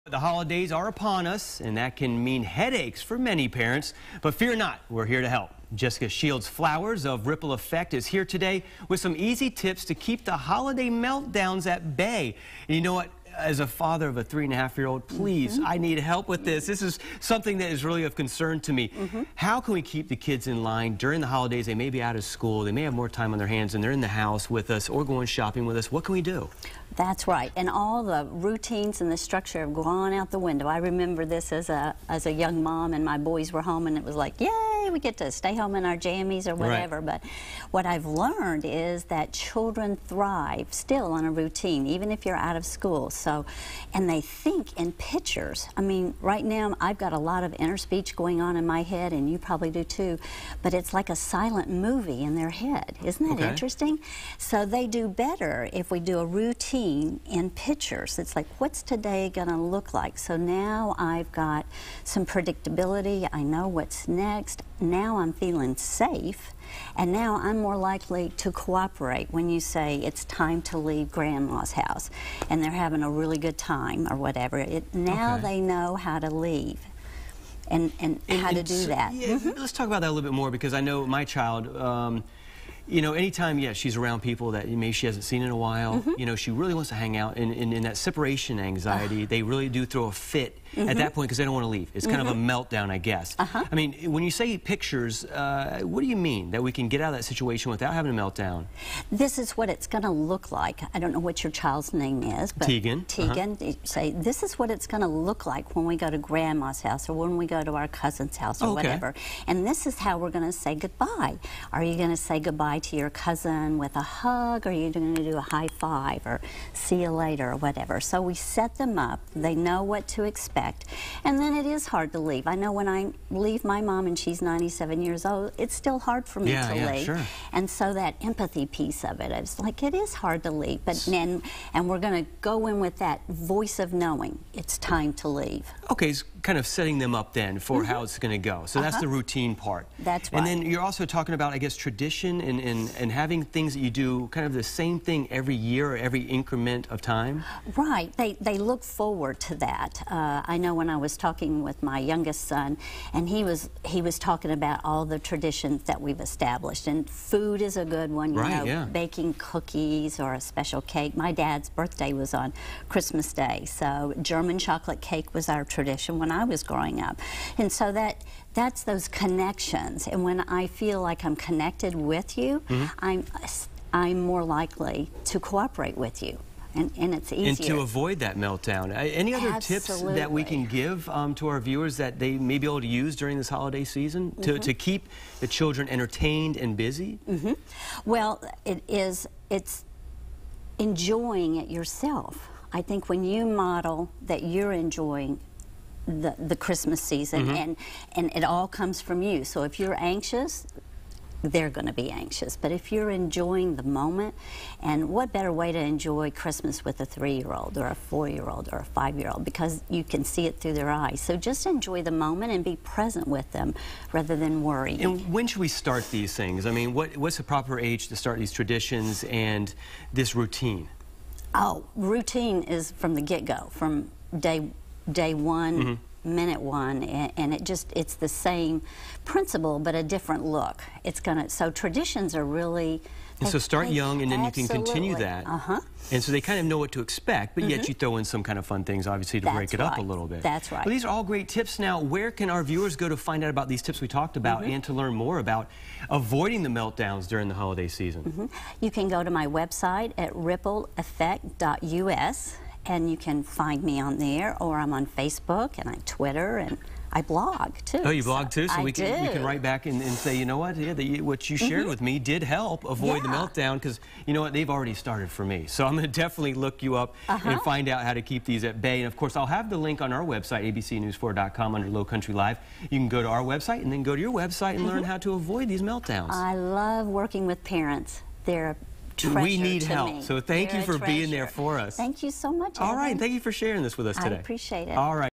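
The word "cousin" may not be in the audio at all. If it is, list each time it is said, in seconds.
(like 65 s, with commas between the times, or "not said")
108 s, 113 s.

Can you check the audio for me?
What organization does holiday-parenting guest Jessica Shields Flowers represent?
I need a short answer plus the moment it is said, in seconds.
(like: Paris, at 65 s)
Ripple Effect, at 7 s.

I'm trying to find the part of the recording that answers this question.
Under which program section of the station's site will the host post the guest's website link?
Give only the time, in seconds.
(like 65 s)
271 s.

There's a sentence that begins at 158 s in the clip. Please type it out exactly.
baking cookies or a special cake.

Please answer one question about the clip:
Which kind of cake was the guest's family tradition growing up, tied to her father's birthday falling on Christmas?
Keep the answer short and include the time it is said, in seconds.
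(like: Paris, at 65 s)
German chocolate cake, at 164 s.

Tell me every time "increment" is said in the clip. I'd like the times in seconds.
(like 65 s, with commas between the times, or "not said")
146 s.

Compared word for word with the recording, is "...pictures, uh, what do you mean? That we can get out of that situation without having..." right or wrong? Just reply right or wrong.
right.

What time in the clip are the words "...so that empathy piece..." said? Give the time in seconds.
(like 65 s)
127 s.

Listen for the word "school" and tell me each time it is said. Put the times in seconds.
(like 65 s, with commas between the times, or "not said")
22 s, 42 s.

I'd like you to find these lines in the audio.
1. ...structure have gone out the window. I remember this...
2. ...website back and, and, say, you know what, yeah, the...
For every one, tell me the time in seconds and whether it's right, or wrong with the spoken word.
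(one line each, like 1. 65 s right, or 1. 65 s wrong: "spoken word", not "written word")
1. 29 s right
2. 259 s wrong: "write", not "website".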